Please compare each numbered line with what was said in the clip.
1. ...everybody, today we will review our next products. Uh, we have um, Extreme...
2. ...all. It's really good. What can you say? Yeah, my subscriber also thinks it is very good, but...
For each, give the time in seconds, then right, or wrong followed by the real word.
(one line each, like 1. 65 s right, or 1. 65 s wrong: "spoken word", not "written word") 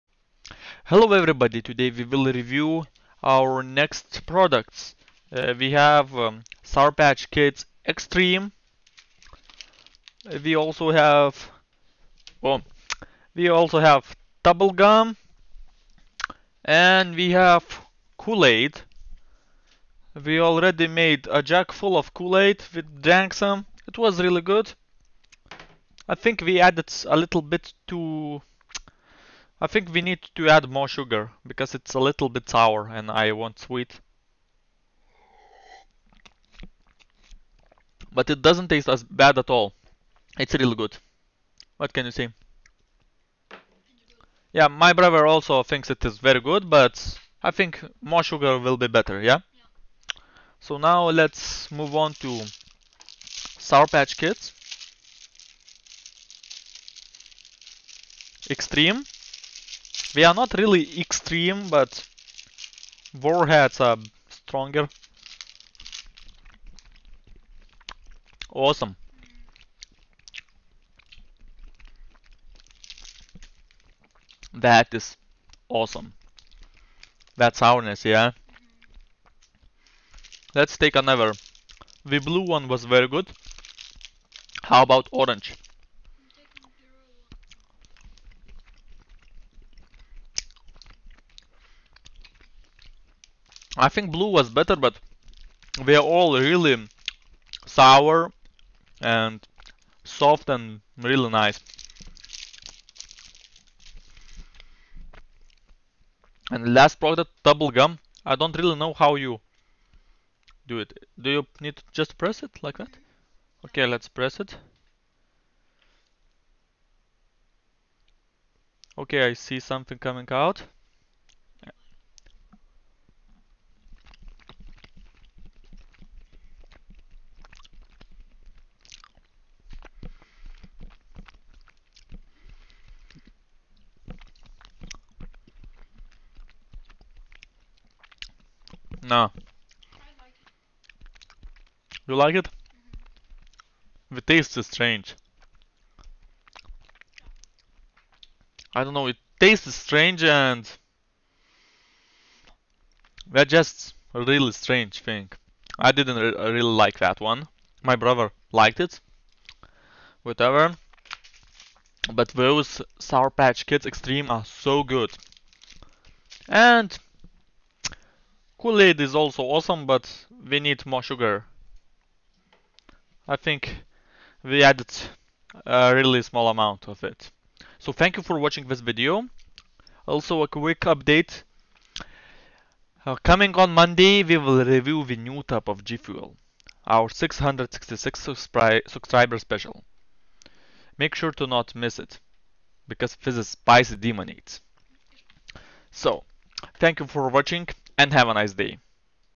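1. 1 s wrong: "Sour", not "Extreme"
2. 39 s wrong: "brother", not "subscriber".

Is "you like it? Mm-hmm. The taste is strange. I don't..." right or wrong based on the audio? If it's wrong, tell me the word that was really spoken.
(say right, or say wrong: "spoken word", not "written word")
right.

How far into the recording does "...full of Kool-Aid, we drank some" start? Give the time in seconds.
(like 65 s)
21 s.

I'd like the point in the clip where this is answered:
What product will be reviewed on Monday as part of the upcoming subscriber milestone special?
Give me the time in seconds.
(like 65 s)
185 s.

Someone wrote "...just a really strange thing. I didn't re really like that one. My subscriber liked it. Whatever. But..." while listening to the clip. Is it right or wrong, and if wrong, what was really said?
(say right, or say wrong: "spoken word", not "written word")
wrong: "brother", not "subscriber".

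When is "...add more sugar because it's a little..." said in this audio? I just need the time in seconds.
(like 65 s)
30 s.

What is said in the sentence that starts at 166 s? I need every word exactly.
And Kool-Aid is also awesome, but we need more sugar.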